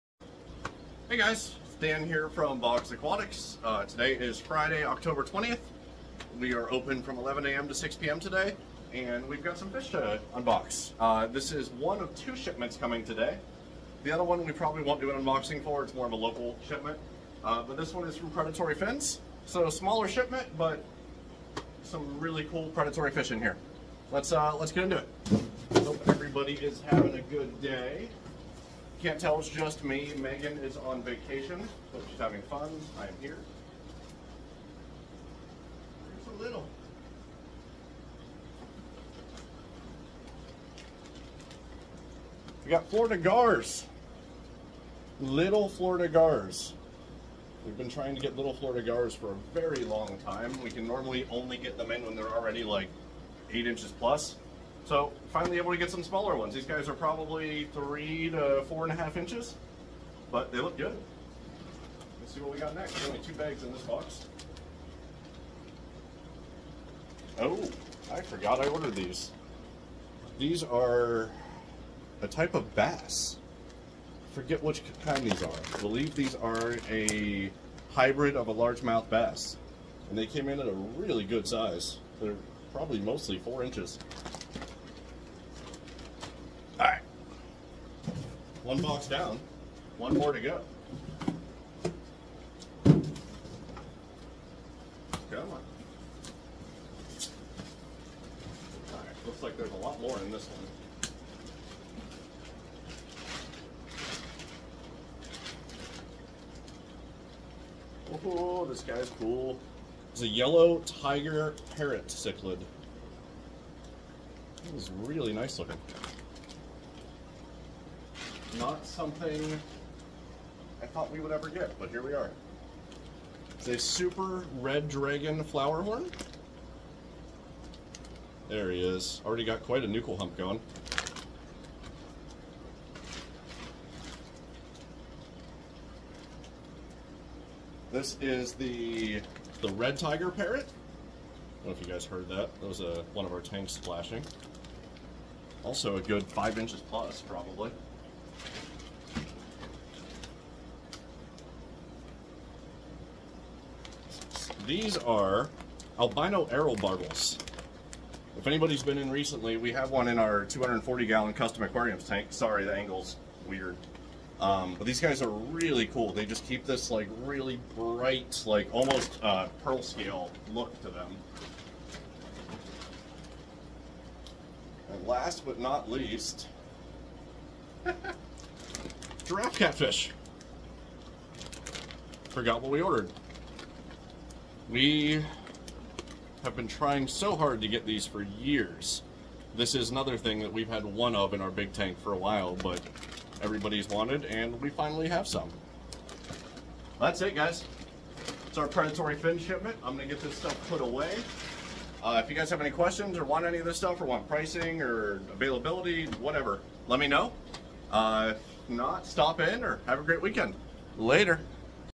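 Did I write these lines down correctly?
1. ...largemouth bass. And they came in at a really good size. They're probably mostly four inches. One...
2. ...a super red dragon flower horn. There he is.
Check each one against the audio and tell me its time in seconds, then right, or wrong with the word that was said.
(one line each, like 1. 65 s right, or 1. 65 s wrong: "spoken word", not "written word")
1. 78 s right
2. 123 s right.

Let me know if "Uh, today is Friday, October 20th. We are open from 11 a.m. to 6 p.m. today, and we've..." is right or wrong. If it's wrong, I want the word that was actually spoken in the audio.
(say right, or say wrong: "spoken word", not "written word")
right.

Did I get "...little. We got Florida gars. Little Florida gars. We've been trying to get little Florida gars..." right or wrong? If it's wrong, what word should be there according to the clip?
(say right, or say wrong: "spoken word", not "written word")
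right.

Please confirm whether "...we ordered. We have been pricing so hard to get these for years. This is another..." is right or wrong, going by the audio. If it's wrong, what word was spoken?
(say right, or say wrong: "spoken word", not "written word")
wrong: "trying", not "pricing".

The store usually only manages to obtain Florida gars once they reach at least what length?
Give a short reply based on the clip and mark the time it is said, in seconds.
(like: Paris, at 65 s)
8 inches, at 53 s.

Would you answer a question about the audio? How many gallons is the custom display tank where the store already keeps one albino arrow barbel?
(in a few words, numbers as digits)
240.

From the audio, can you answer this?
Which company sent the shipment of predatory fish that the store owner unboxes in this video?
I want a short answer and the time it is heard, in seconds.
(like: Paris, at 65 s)
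Predatory Fins, at 18 s.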